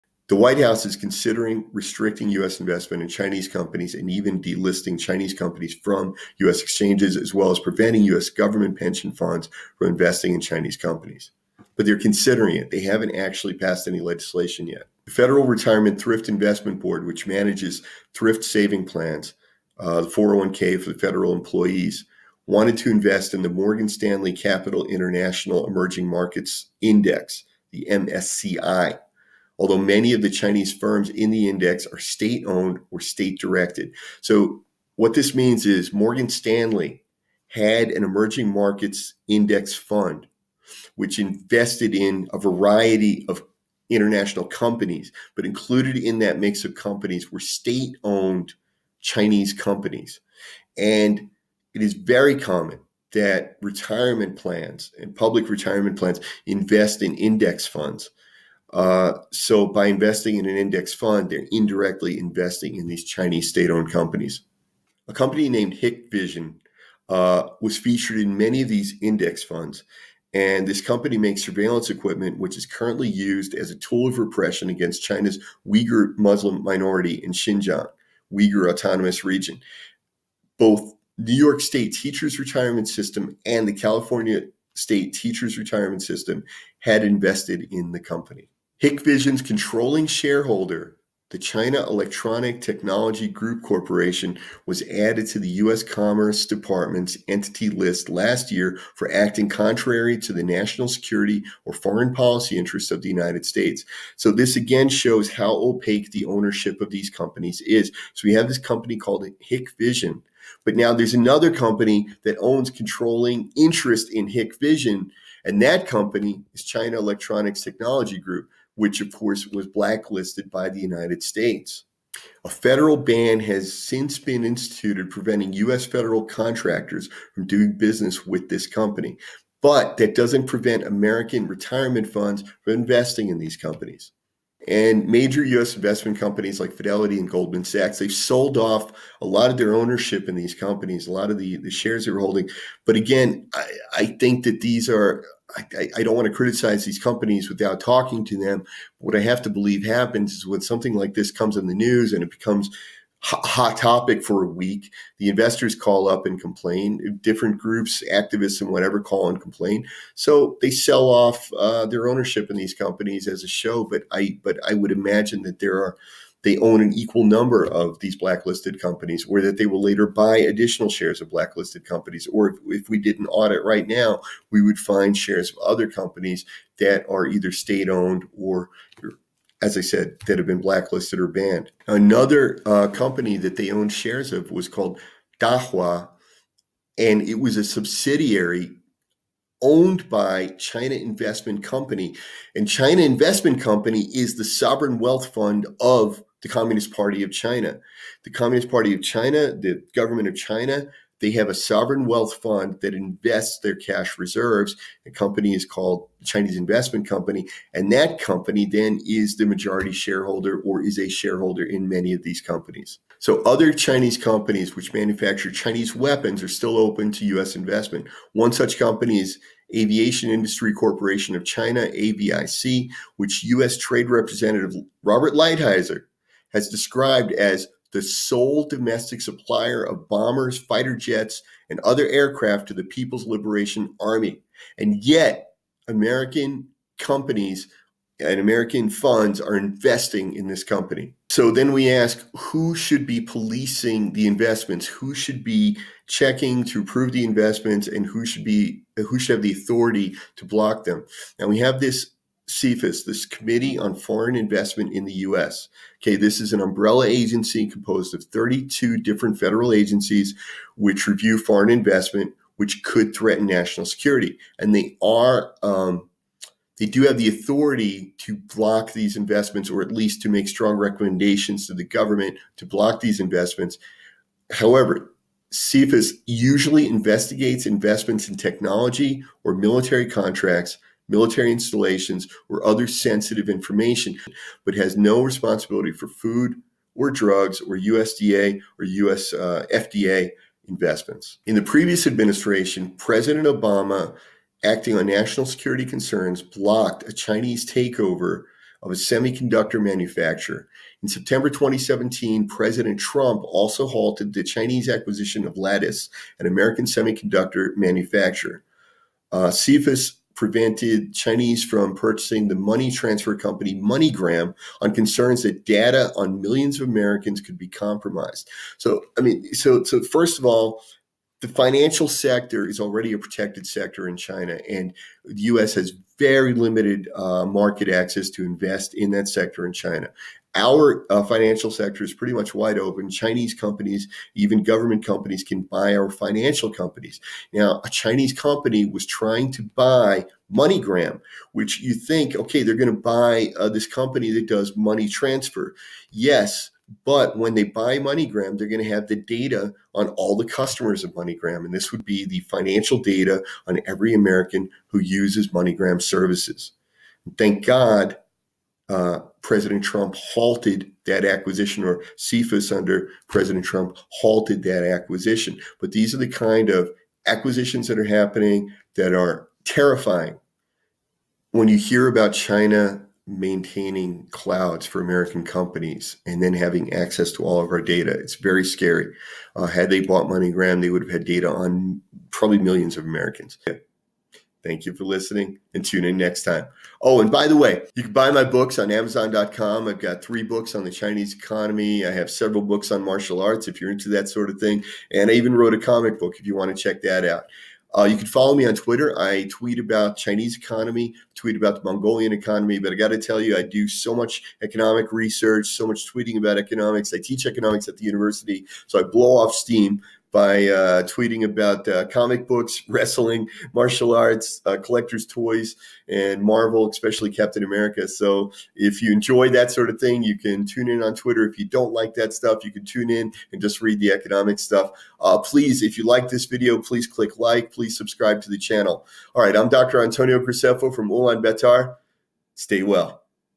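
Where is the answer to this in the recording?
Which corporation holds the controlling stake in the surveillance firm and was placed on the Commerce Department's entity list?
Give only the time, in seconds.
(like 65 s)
91 s.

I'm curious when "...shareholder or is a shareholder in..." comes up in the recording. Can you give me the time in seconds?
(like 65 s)
209 s.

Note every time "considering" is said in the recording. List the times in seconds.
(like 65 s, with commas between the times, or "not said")
0 s, 11 s.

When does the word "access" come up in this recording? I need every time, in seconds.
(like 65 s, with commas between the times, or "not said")
327 s, 376 s.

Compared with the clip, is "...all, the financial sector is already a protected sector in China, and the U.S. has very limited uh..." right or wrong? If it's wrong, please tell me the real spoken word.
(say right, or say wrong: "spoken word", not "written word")
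right.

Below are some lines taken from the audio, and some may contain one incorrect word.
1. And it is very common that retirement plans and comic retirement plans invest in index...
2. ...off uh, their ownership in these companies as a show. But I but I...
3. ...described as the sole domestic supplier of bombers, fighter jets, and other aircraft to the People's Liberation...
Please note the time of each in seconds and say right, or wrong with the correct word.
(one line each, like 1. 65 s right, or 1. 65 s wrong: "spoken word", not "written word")
1. 50 s wrong: "public", not "comic"
2. 161 s right
3. 226 s right.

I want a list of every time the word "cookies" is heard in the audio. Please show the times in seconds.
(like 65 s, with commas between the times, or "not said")
not said.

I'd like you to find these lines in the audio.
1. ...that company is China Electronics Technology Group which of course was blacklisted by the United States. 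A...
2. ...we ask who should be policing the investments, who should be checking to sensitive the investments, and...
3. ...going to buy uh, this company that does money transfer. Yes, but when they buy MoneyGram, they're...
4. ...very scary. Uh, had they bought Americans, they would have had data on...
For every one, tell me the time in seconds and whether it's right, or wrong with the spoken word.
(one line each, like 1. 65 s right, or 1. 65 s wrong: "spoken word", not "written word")
1. 115 s right
2. 241 s wrong: "approve", not "sensitive"
3. 342 s right
4. 378 s wrong: "MoneyGram", not "Americans".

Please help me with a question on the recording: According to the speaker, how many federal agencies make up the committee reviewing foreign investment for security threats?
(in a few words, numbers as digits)
32.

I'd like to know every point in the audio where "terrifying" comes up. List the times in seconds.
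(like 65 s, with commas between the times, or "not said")
369 s.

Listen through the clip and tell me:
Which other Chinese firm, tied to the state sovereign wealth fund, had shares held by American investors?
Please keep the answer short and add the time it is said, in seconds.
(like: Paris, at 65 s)
Dahua, at 185 s.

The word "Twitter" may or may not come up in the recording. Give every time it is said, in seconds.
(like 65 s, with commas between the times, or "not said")
398 s, 421 s.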